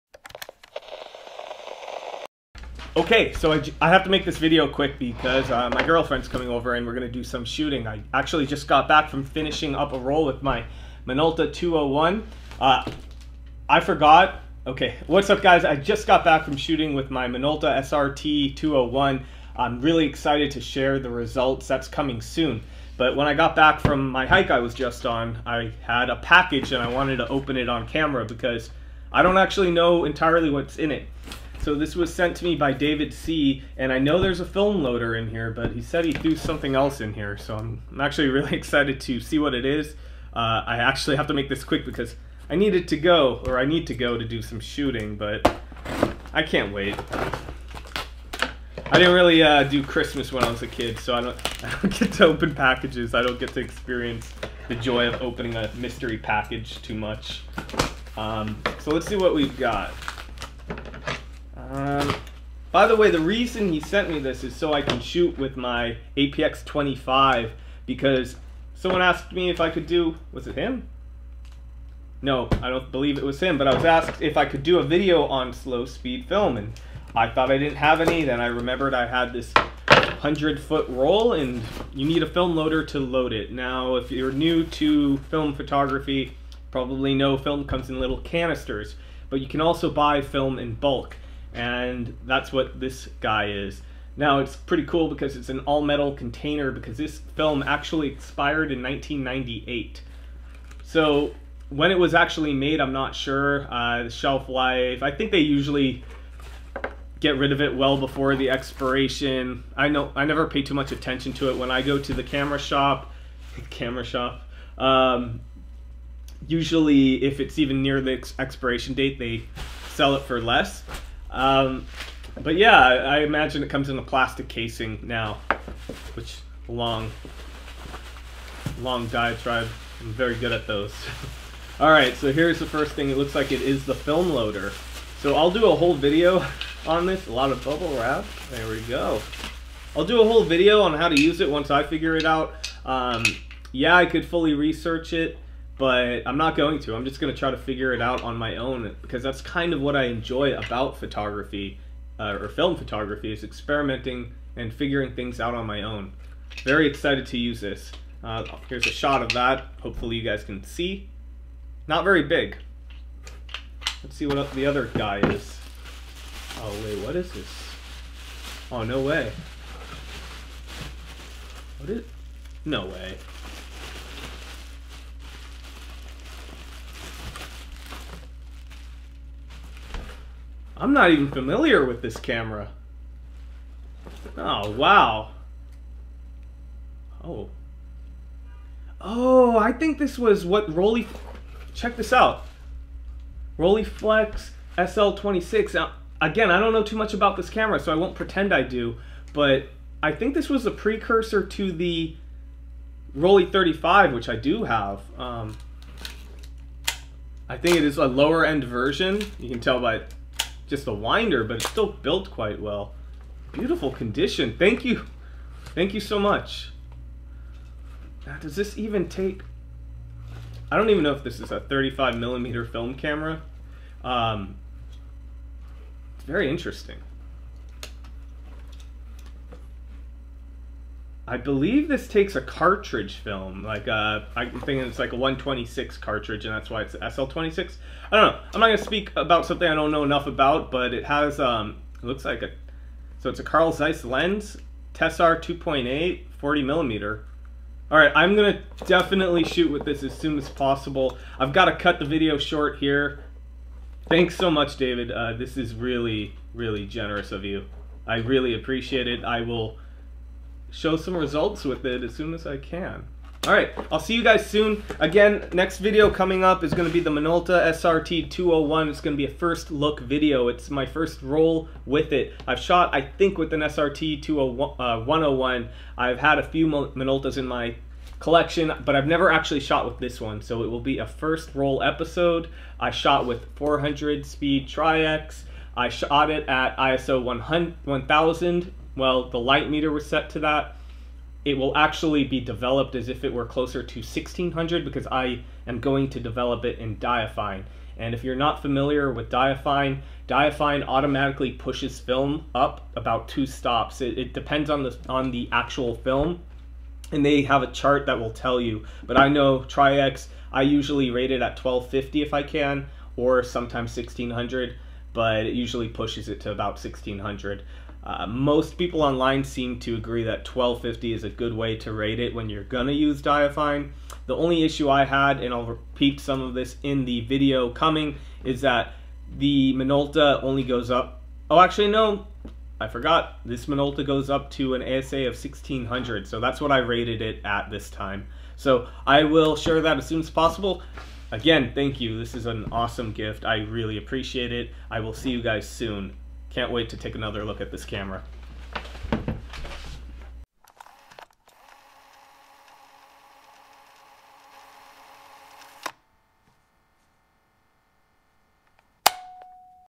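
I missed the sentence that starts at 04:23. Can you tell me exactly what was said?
All right, I'll see you guys soon.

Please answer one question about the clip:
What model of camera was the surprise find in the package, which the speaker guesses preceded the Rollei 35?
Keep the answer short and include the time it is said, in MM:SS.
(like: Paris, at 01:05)
Rolleiflex SL26, at 03:13.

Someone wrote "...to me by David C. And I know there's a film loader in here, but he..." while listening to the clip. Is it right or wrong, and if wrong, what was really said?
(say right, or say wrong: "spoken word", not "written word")
right.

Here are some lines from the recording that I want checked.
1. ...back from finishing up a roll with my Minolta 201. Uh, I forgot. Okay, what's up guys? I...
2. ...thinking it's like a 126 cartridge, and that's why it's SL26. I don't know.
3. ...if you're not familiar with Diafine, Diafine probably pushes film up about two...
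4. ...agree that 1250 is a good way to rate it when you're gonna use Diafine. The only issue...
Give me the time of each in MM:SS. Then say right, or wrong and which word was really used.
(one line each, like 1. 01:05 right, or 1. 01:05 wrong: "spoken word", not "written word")
1. 00:08 right
2. 03:54 right
3. 04:58 wrong: "automatically", not "probably"
4. 05:19 right.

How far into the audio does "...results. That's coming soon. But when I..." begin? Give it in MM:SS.
00:21.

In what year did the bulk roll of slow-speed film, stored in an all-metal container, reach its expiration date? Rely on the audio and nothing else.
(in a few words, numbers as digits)
1998.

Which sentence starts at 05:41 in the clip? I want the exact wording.
Again, thank you, this is an awesome gift, I really appreciate it.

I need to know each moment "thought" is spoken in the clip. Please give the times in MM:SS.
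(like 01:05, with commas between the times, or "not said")
01:17.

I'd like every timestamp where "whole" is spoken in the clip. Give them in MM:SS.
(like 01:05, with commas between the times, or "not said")
02:15, 02:20.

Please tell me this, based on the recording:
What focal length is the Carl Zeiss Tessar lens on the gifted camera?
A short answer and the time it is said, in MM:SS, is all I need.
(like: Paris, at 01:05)
40 millimeter, at 04:06.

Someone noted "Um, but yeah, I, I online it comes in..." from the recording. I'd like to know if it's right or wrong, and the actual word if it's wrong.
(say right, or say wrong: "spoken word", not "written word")
wrong: "imagine", not "online".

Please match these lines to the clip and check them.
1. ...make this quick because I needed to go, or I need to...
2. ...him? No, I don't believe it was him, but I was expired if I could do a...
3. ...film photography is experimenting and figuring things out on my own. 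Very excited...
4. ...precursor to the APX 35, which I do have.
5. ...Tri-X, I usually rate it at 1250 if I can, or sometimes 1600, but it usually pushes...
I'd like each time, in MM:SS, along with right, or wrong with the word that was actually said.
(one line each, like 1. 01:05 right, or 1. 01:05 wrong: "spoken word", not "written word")
1. 00:41 right
2. 01:10 wrong: "asked", not "expired"
3. 02:32 right
4. 03:20 wrong: "Rollei", not "APX"
5. 05:09 right.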